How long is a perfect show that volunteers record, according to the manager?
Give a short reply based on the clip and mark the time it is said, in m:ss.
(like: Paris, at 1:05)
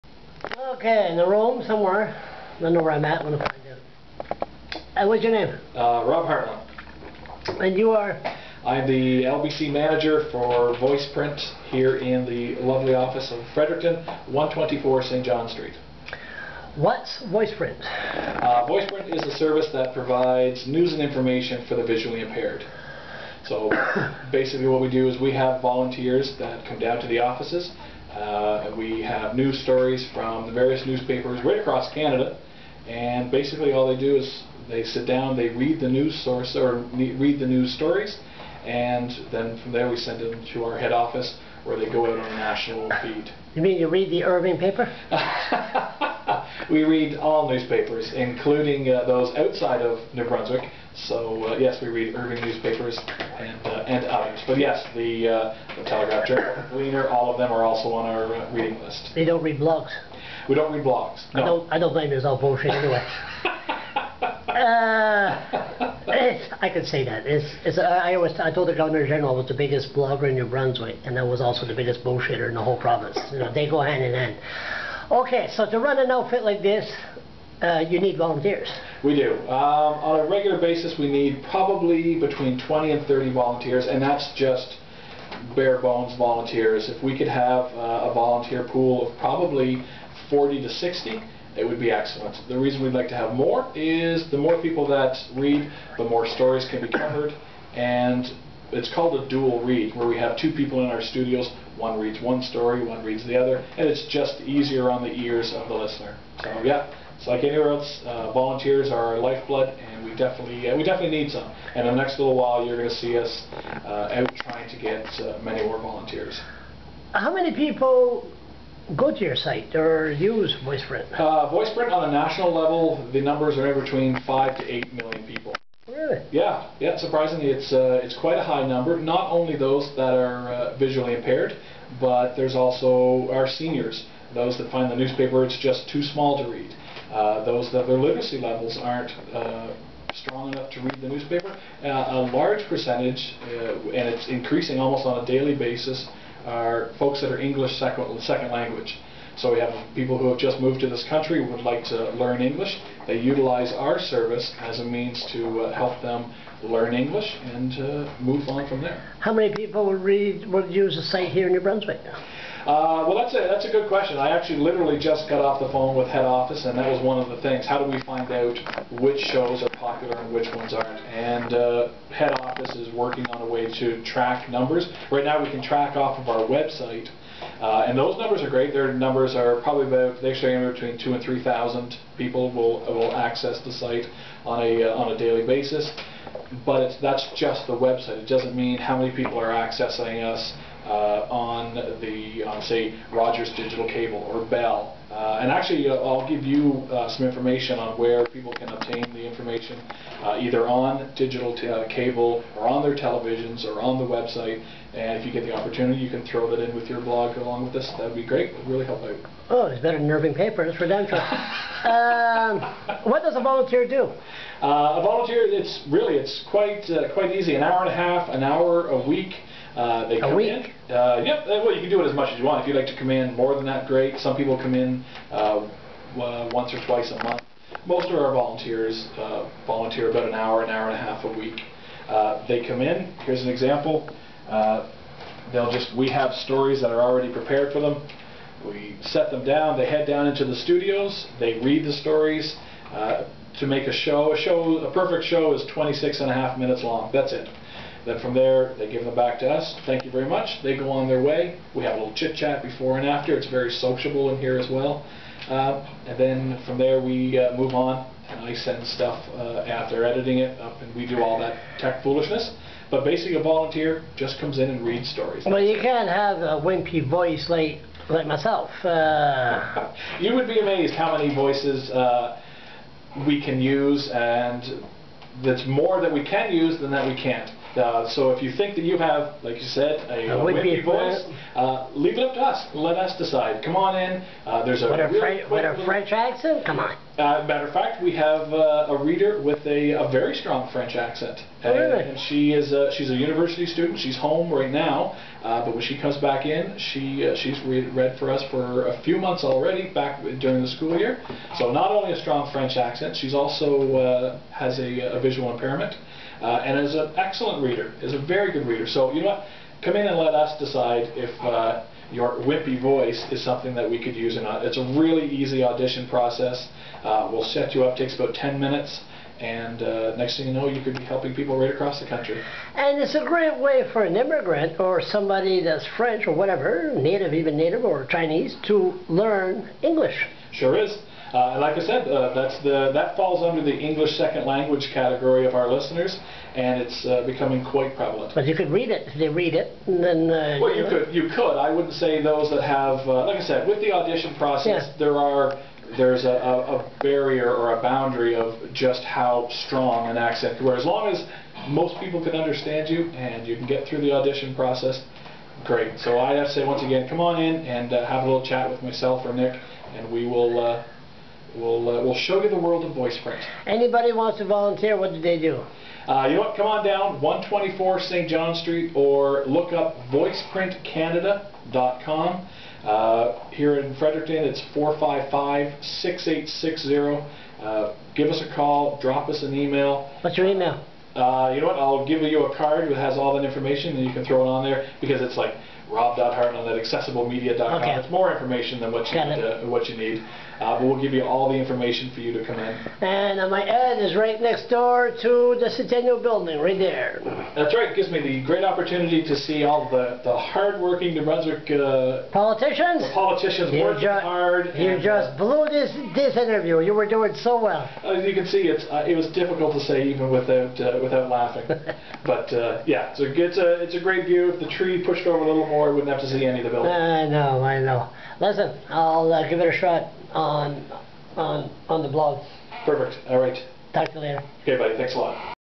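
26 and a half minutes, at 4:05.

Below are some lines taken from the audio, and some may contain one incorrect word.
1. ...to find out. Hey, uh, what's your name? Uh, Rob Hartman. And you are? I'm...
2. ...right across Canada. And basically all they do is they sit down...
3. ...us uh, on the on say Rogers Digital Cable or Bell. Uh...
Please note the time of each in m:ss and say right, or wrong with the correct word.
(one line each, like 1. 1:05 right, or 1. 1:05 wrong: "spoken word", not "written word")
1. 0:03 right
2. 0:31 right
3. 3:10 right.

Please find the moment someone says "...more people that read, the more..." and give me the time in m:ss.
1:34.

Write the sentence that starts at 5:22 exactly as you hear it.
And it's a great way for an immigrant or somebody that's French or whatever, native, even native or Chinese, to learn English.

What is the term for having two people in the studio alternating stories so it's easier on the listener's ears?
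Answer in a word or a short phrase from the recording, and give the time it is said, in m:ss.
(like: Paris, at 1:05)
dual read, at 1:39.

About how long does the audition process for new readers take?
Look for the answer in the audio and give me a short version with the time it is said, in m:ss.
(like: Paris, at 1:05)
10 minutes, at 5:18.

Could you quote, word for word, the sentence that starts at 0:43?
You mean you read the Irving paper?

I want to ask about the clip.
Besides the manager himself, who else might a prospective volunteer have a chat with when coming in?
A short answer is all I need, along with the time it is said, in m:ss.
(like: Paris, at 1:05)
Nick, at 5:59.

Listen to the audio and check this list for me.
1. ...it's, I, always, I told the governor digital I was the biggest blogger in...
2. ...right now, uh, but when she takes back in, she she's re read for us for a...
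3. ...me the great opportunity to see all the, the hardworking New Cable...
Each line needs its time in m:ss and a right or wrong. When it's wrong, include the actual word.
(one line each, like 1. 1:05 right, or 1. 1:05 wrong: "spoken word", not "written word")
1. 1:07 wrong: "general", not "digital"
2. 4:54 wrong: "comes", not "takes"
3. 6:38 wrong: "Brunswick", not "Cable".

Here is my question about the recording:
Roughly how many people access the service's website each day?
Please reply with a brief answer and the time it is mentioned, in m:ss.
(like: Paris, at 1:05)
2,000 to 3,000, at 3:00.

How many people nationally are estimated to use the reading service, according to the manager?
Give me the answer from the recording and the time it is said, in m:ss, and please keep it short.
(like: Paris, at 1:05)
5 to 8 million, at 2:04.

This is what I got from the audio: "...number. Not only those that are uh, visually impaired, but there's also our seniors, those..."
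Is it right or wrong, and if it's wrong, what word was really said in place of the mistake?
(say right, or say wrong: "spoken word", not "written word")
right.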